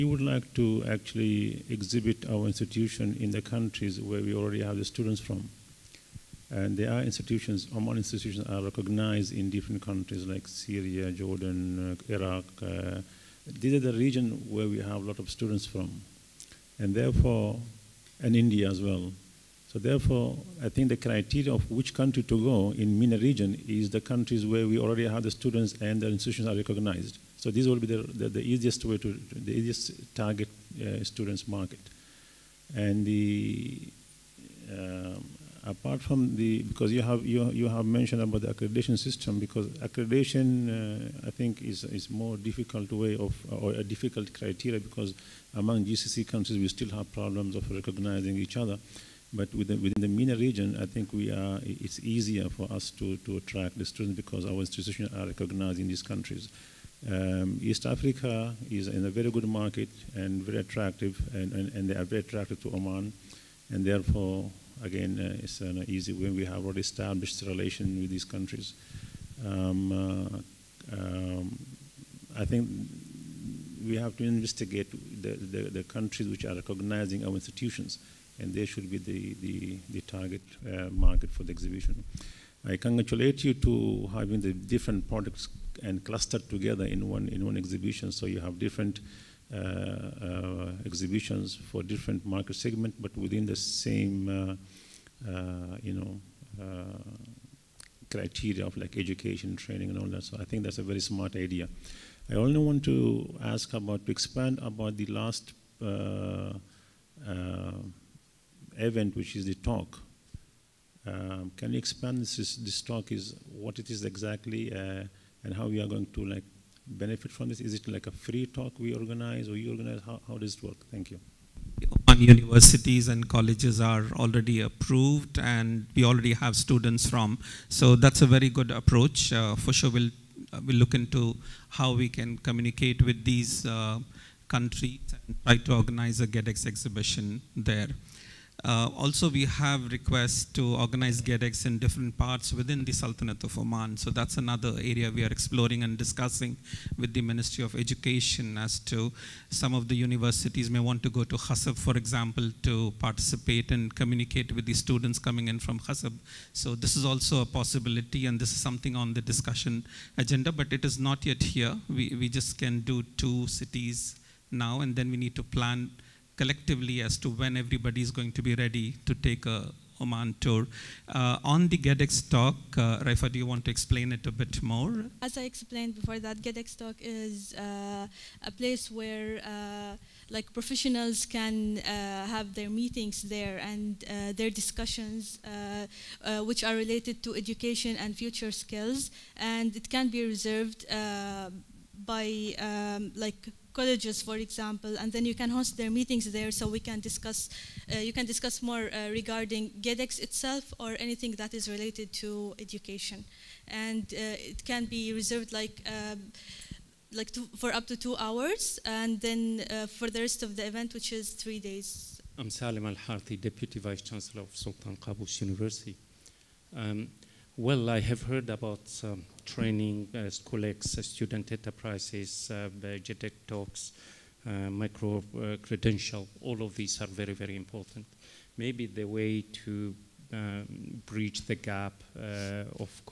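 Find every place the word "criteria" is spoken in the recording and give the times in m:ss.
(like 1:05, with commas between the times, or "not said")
0:20, 0:44, 1:38.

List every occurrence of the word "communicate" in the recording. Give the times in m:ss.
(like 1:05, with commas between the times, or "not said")
2:12, 2:33.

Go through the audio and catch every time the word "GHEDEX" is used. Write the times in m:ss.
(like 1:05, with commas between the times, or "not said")
2:16, 2:21, 2:51, 2:56, 3:19.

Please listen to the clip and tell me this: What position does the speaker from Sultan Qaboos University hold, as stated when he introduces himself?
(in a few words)
Deputy Vice Chancellor.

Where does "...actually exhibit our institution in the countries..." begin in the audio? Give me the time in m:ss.
0:00.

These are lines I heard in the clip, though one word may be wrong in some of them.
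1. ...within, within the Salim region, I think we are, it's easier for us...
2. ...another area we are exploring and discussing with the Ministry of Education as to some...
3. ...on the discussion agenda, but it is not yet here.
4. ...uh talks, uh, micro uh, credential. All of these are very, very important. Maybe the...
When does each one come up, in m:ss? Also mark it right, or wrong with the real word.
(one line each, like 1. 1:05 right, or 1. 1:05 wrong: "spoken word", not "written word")
1. 0:49 wrong: "MENA", not "Salim"
2. 2:24 right
3. 2:38 right
4. 3:42 right.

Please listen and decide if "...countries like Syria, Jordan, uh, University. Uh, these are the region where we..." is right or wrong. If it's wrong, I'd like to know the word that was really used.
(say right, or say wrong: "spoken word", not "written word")
wrong: "Iraq", not "University".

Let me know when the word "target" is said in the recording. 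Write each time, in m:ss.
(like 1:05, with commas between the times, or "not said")
0:30, 1:20.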